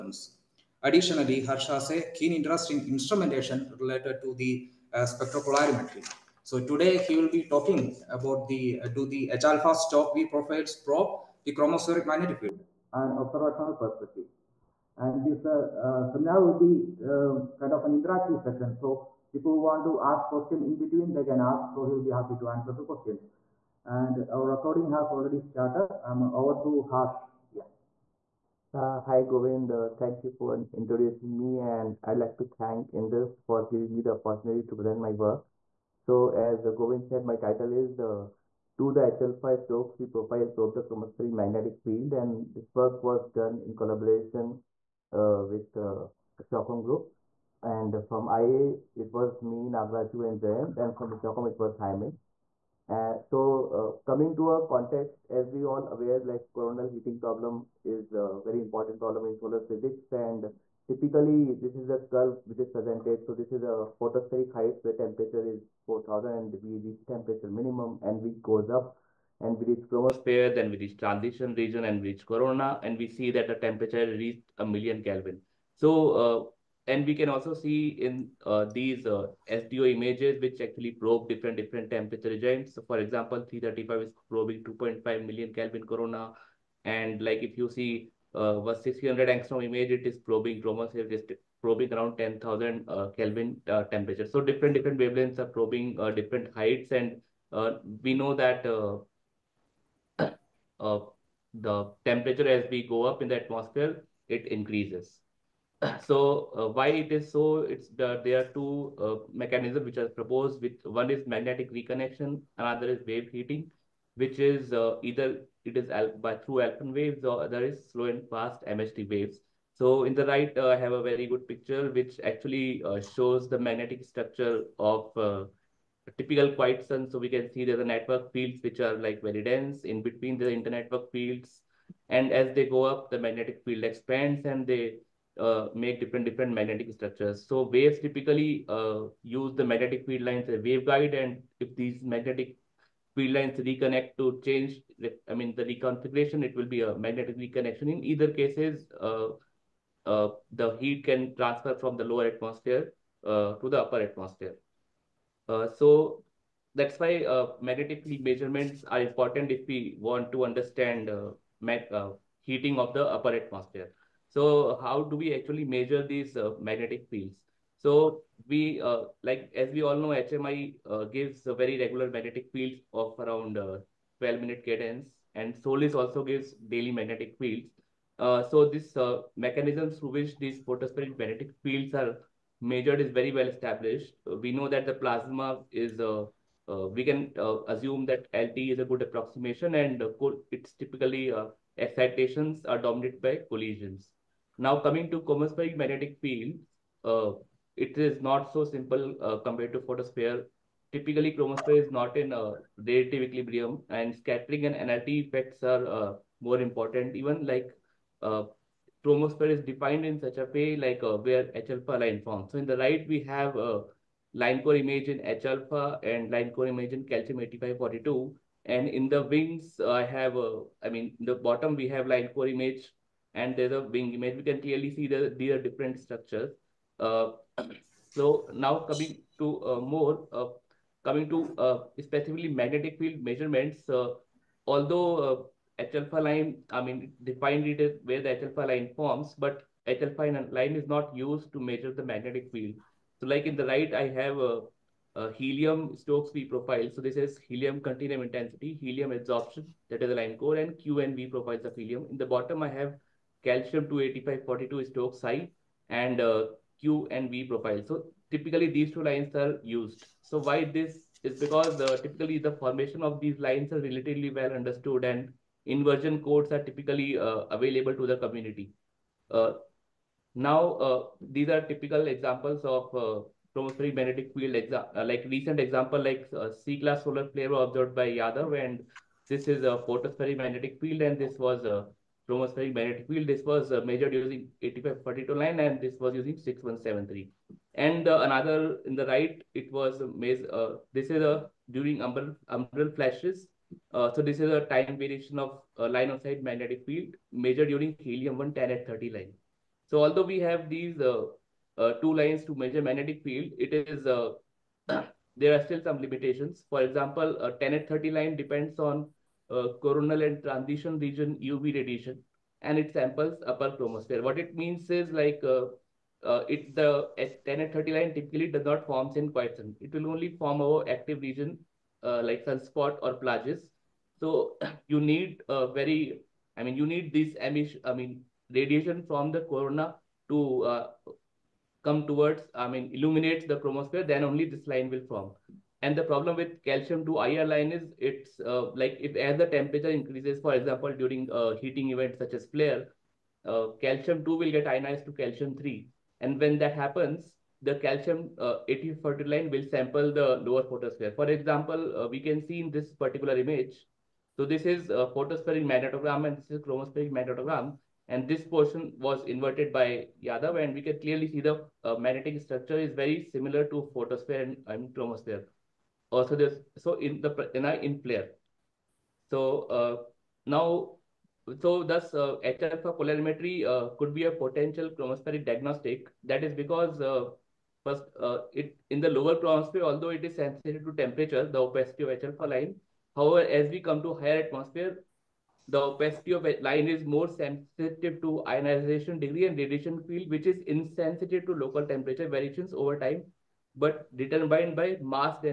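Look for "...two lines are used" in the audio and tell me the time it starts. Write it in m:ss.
4:18.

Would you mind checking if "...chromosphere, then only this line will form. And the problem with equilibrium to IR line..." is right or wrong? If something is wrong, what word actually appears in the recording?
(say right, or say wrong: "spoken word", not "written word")
wrong: "calcium", not "equilibrium".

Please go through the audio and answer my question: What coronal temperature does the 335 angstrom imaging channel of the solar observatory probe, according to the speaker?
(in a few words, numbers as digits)
2.5 million Kelvin.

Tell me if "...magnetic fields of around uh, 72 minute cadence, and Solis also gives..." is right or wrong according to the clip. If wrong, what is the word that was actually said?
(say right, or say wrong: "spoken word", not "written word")
wrong: "12", not "72".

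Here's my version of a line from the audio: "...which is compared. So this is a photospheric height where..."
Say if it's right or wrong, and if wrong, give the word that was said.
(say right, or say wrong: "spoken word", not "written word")
wrong: "presented", not "compared".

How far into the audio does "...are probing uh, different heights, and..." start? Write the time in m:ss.
1:35.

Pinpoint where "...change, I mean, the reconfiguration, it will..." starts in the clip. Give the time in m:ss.
2:24.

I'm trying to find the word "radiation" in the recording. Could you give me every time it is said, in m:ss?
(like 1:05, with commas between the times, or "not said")
5:11, 5:28, 6:29.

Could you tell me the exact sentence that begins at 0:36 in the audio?
So as Govind said, my title is uh, To the HLF 5 Stokes, we profile probe the chromospheric magnetic field.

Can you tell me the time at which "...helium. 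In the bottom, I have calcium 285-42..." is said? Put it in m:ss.
4:11.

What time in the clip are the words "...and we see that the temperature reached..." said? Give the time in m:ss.
1:12.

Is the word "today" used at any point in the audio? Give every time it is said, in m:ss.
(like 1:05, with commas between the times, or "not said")
0:06.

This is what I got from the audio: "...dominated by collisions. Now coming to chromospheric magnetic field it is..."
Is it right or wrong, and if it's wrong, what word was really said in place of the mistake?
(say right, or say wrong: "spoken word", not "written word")
right.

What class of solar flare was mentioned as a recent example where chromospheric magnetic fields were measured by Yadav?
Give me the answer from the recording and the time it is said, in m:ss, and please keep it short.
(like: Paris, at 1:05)
C-class, at 4:36.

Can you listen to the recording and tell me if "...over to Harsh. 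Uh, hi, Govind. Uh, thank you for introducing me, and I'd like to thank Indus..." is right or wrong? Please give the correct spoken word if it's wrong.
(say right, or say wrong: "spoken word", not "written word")
right.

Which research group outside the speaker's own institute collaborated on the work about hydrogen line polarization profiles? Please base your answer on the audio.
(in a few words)
Stockholm Group.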